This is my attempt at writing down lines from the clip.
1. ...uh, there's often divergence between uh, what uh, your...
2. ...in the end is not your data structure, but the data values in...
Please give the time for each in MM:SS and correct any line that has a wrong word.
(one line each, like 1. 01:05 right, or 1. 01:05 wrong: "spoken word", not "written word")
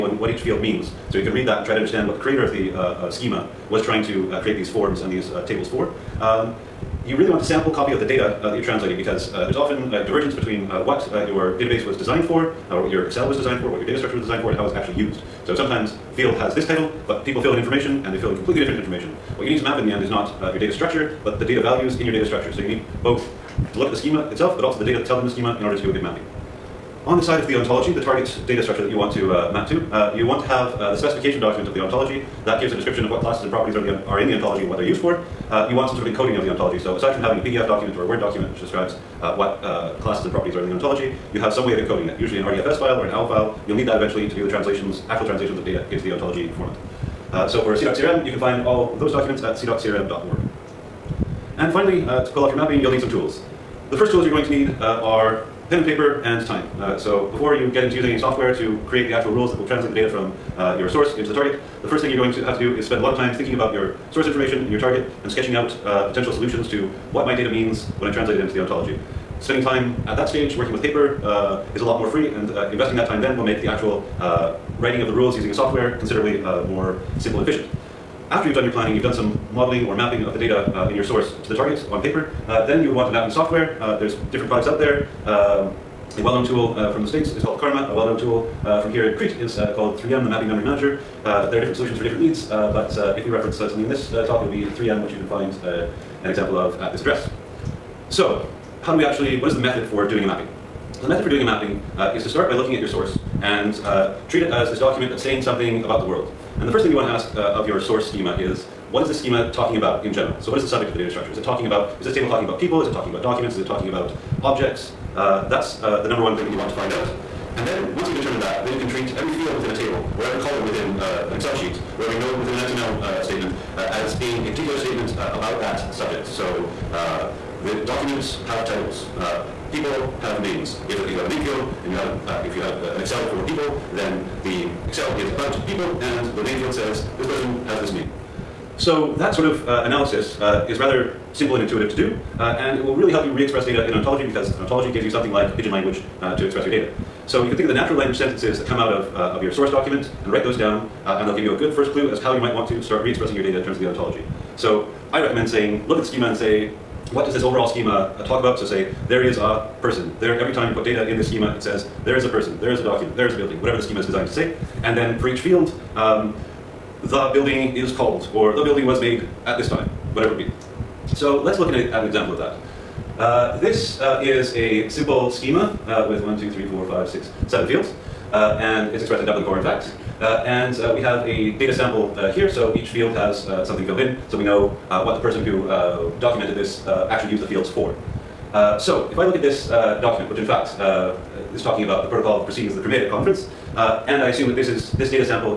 1. 00:09 right
2. 00:19 right.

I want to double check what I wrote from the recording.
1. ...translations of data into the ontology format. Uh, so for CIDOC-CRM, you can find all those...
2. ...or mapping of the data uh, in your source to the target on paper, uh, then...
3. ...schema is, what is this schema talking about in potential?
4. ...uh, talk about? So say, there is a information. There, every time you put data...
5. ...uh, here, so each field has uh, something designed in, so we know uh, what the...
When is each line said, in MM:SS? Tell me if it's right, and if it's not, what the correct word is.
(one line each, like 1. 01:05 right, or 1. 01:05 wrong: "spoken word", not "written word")
1. 00:45 right
2. 01:19 right
3. 01:48 wrong: "general", not "potential"
4. 02:37 wrong: "person", not "information"
5. 03:02 wrong: "filled", not "designed".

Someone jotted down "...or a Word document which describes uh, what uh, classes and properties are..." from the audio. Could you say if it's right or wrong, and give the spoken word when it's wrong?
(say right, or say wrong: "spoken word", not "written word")
right.